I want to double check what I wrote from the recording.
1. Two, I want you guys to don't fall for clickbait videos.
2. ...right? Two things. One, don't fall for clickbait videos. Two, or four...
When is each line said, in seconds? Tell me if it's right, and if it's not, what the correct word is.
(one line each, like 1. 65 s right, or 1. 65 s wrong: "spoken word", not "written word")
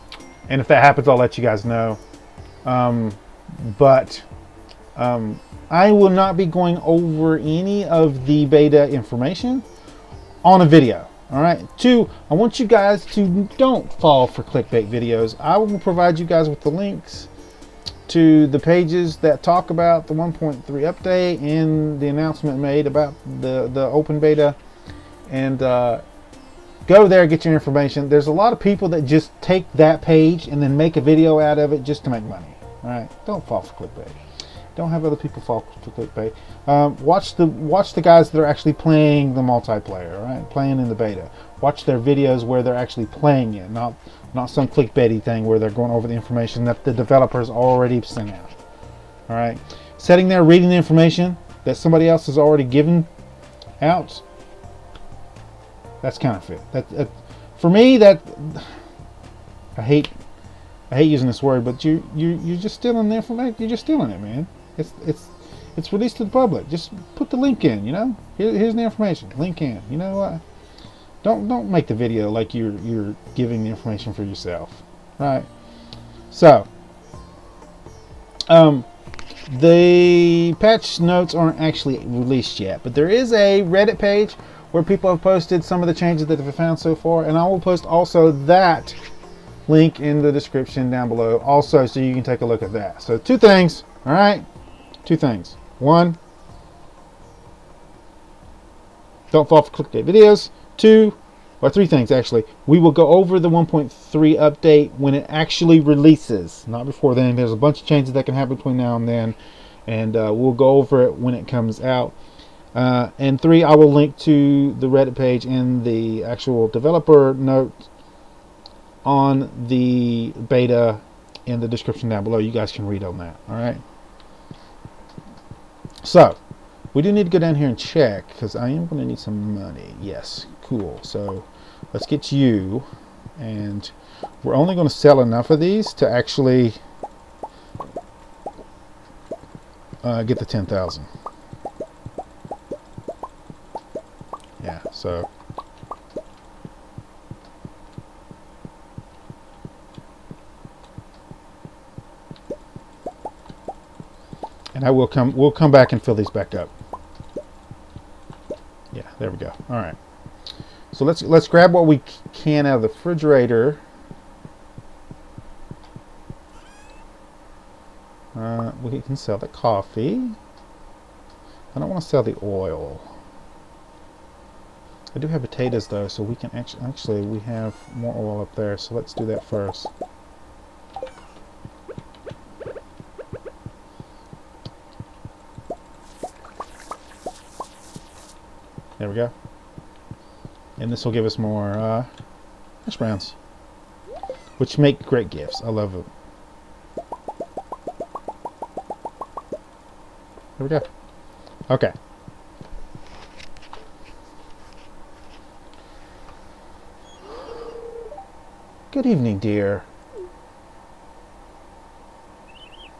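1. 11 s right
2. 94 s wrong: "three", not "four".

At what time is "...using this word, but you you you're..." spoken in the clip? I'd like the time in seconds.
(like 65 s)
61 s.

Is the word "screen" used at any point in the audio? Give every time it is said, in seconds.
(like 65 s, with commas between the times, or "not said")
not said.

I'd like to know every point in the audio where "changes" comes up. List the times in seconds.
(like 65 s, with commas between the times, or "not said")
85 s, 107 s.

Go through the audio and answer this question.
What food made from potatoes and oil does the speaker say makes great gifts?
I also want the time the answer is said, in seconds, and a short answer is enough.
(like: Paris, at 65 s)
hash browns, at 192 s.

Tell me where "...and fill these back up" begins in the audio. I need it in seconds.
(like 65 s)
155 s.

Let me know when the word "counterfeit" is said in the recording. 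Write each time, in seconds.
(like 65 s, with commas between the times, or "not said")
56 s.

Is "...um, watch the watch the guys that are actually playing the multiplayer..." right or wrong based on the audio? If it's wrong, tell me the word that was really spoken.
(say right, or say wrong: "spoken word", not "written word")
right.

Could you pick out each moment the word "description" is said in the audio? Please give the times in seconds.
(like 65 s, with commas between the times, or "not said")
90 s, 121 s.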